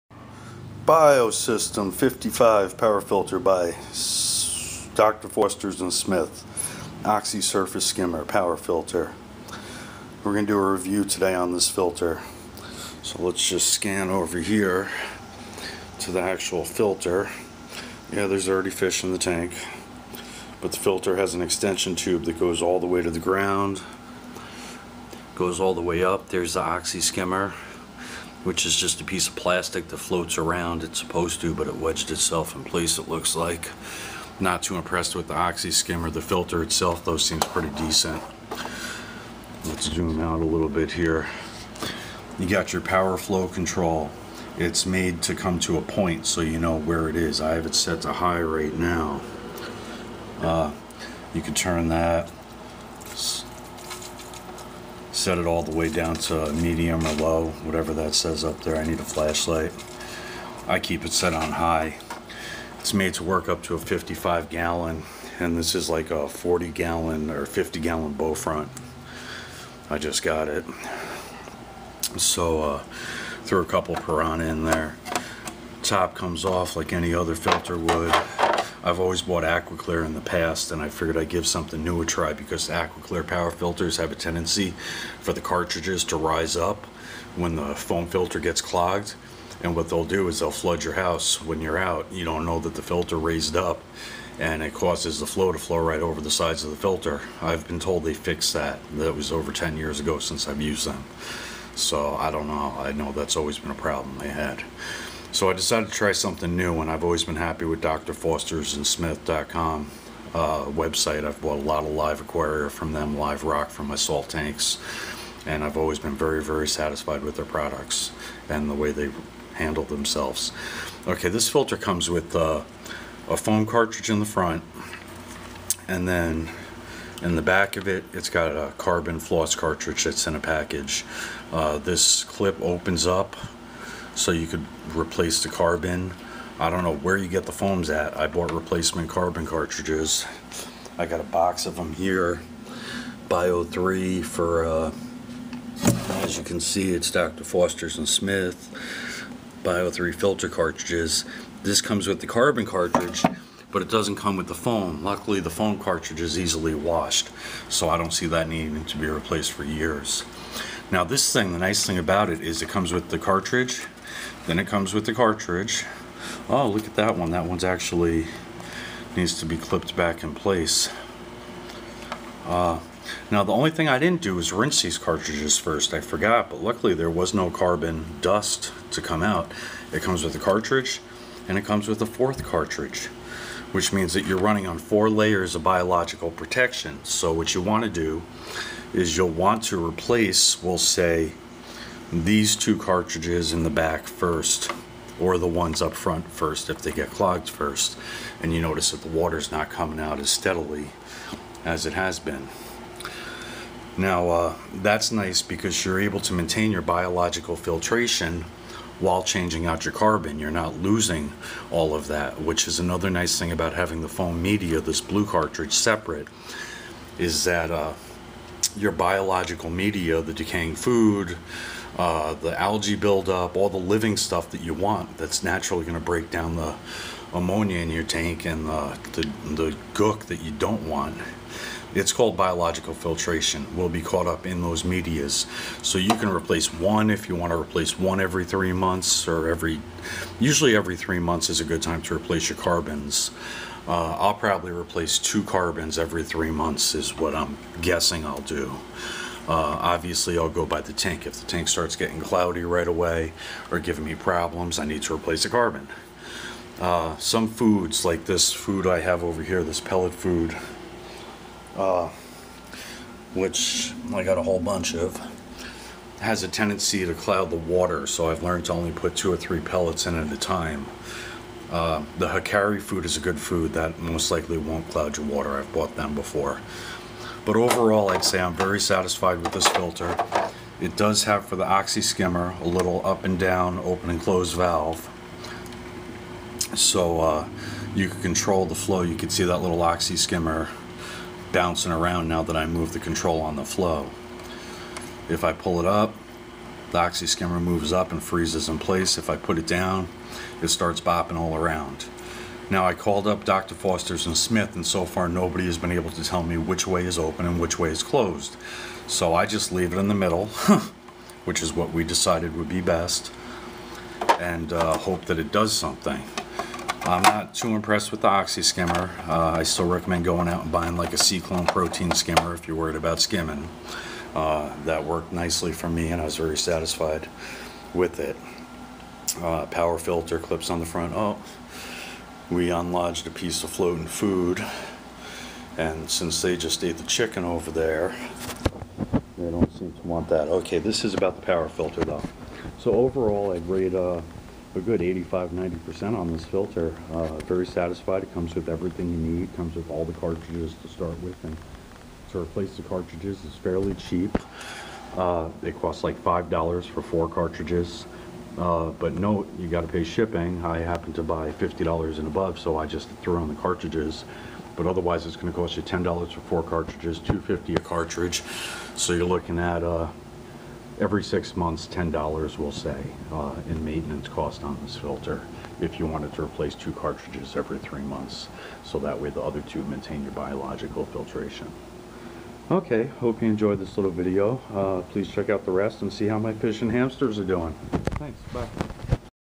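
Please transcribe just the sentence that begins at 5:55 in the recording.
Uh, it costs like $5 for four cartridges.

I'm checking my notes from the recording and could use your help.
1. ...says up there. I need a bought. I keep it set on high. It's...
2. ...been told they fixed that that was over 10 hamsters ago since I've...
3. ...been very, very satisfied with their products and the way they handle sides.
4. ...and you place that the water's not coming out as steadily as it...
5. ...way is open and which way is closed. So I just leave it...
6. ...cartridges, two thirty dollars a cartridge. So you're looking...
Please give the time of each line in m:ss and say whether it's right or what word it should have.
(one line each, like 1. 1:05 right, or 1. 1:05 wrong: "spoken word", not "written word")
1. 0:58 wrong: "flashlight", not "bought"
2. 1:37 wrong: "years", not "hamsters"
3. 1:55 wrong: "themselves", not "sides"
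4. 3:18 wrong: "notice", not "place"
5. 5:06 right
6. 6:06 wrong: "fifty", not "thirty".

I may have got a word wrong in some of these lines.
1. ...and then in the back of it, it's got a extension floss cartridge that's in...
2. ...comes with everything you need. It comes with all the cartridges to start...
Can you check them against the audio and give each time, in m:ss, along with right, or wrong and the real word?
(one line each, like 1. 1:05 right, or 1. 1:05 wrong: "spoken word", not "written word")
1. 2:05 wrong: "carbon", not "extension"
2. 5:48 right.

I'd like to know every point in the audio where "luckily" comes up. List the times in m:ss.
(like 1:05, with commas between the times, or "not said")
2:35, 2:56.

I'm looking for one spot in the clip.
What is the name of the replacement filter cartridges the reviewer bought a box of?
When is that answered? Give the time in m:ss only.
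2:29.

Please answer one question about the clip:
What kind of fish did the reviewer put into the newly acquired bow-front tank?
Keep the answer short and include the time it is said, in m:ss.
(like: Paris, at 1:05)
Piranha, at 1:13.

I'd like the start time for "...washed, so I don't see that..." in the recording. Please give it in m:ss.
2:36.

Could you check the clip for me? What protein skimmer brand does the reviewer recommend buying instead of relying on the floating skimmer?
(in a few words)
SeaClone.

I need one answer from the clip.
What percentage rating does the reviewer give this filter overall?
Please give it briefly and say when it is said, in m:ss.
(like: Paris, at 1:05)
85-90%, at 5:45.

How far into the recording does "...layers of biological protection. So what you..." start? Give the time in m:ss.
3:05.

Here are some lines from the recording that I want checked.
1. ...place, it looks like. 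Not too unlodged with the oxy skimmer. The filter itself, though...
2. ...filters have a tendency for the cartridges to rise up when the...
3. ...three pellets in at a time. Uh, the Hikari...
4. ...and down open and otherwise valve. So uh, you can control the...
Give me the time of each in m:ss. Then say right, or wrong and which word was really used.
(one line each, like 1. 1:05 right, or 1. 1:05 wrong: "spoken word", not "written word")
1. 0:32 wrong: "impressed", not "unlodged"
2. 1:23 right
3. 4:29 right
4. 4:43 wrong: "close", not "otherwise".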